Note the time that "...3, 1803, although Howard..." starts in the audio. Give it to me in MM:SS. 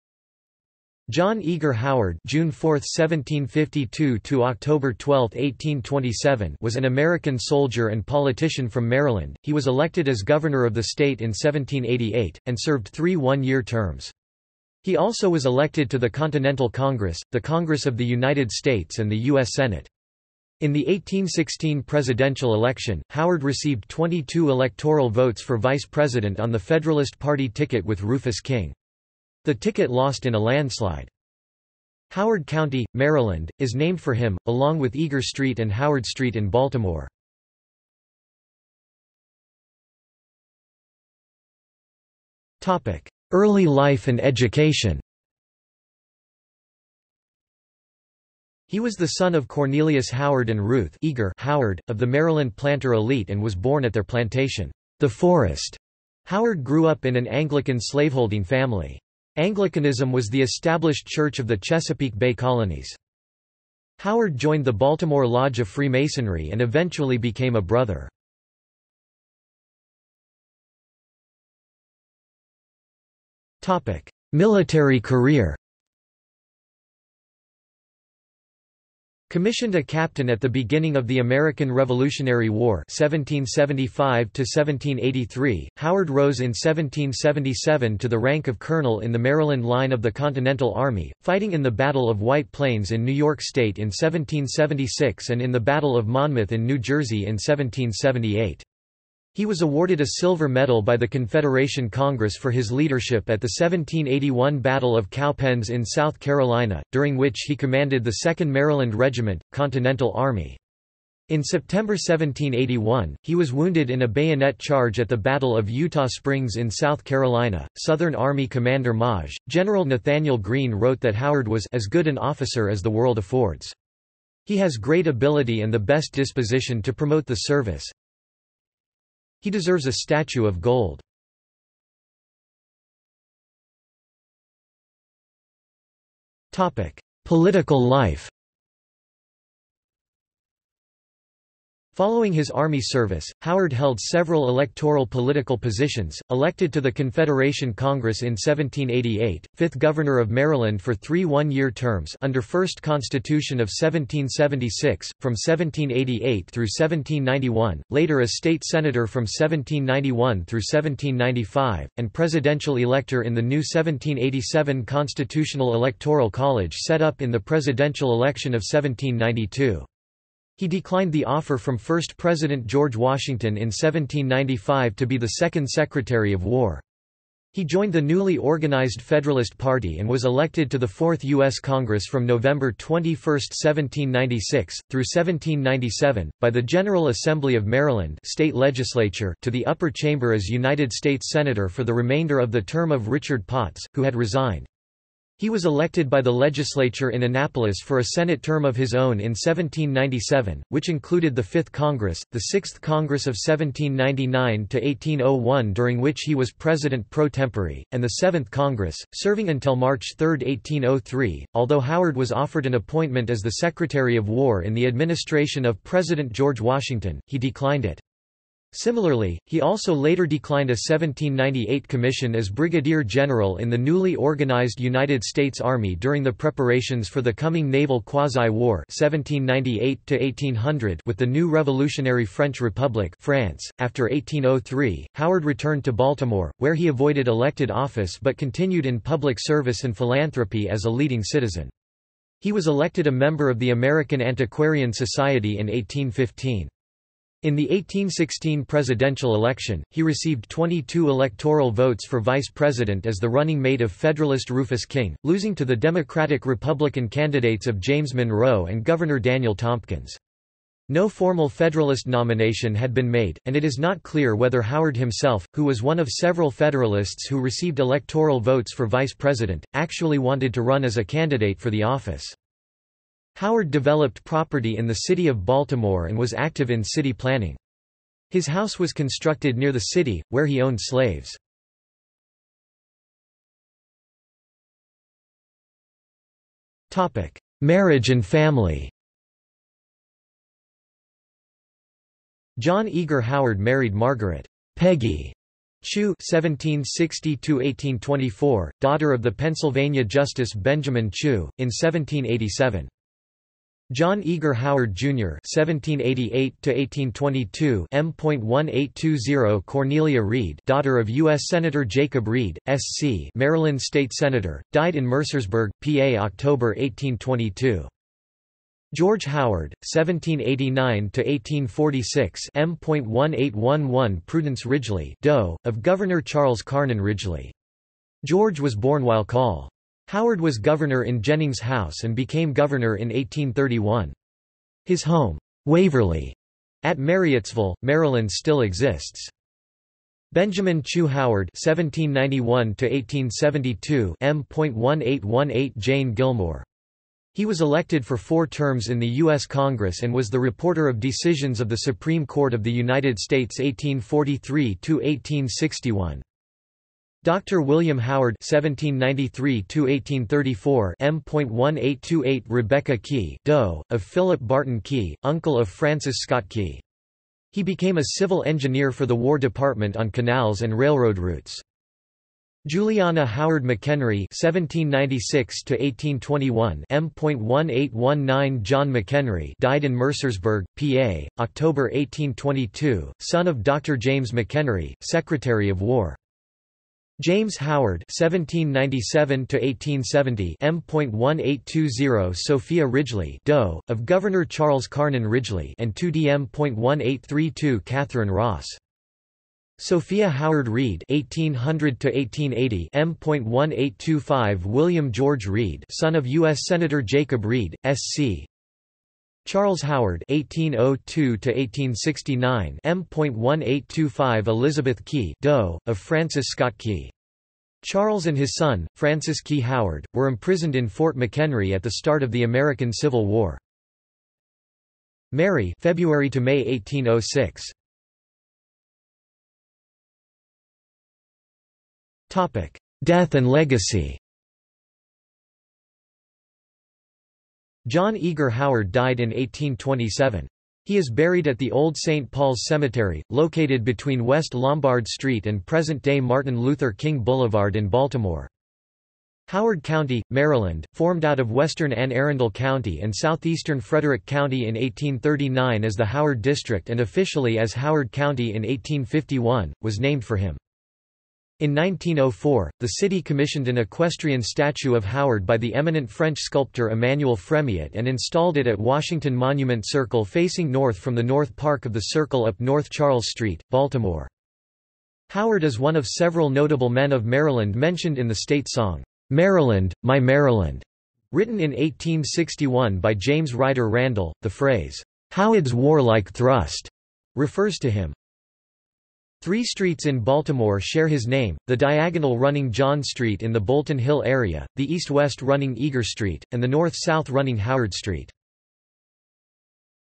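03:30.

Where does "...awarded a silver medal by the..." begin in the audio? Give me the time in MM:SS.
01:39.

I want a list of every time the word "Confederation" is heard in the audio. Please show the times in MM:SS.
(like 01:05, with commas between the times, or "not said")
01:41, 02:26.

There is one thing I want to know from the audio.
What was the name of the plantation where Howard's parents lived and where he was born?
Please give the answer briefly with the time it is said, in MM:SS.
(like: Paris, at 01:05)
The Forest, at 00:54.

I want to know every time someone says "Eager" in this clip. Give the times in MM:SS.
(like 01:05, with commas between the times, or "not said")
00:01, 00:34, 00:51, 04:52, 05:04, 07:18, 08:15.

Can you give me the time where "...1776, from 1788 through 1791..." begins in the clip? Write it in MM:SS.
02:33.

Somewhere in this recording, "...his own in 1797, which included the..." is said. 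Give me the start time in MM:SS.
03:18.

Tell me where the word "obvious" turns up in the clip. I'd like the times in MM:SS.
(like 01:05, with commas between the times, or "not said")
not said.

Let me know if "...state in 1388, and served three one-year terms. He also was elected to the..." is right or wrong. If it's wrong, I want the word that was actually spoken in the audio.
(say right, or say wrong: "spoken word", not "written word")
wrong: "1788", not "1388".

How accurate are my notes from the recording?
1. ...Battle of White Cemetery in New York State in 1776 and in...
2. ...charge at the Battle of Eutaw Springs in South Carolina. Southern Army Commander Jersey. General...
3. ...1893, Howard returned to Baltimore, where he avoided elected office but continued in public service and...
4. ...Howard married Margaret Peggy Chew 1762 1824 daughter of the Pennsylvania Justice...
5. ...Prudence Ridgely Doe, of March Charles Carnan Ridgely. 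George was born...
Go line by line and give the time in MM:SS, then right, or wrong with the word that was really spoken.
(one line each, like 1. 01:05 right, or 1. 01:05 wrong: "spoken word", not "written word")
1. 01:31 wrong: "Plains", not "Cemetery"
2. 01:54 wrong: "Maj", not "Jersey"
3. 03:54 wrong: "1803", not "1893"
4. 04:53 right
5. 05:24 wrong: "Governor", not "March".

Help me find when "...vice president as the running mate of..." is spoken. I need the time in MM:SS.
04:12.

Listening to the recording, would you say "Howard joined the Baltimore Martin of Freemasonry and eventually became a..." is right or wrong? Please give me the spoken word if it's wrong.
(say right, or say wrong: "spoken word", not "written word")
wrong: "Lodge", not "Martin".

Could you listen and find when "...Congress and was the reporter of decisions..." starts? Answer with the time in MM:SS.
05:49.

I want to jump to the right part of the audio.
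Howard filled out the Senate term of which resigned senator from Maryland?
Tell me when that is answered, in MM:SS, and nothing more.
03:13.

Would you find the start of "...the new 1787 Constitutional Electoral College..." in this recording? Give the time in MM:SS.
02:43.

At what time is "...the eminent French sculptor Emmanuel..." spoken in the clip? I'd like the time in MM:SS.
07:45.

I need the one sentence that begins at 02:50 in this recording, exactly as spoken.
He declined the offer from first President George Washington in 1795 to be the second Secretary of War.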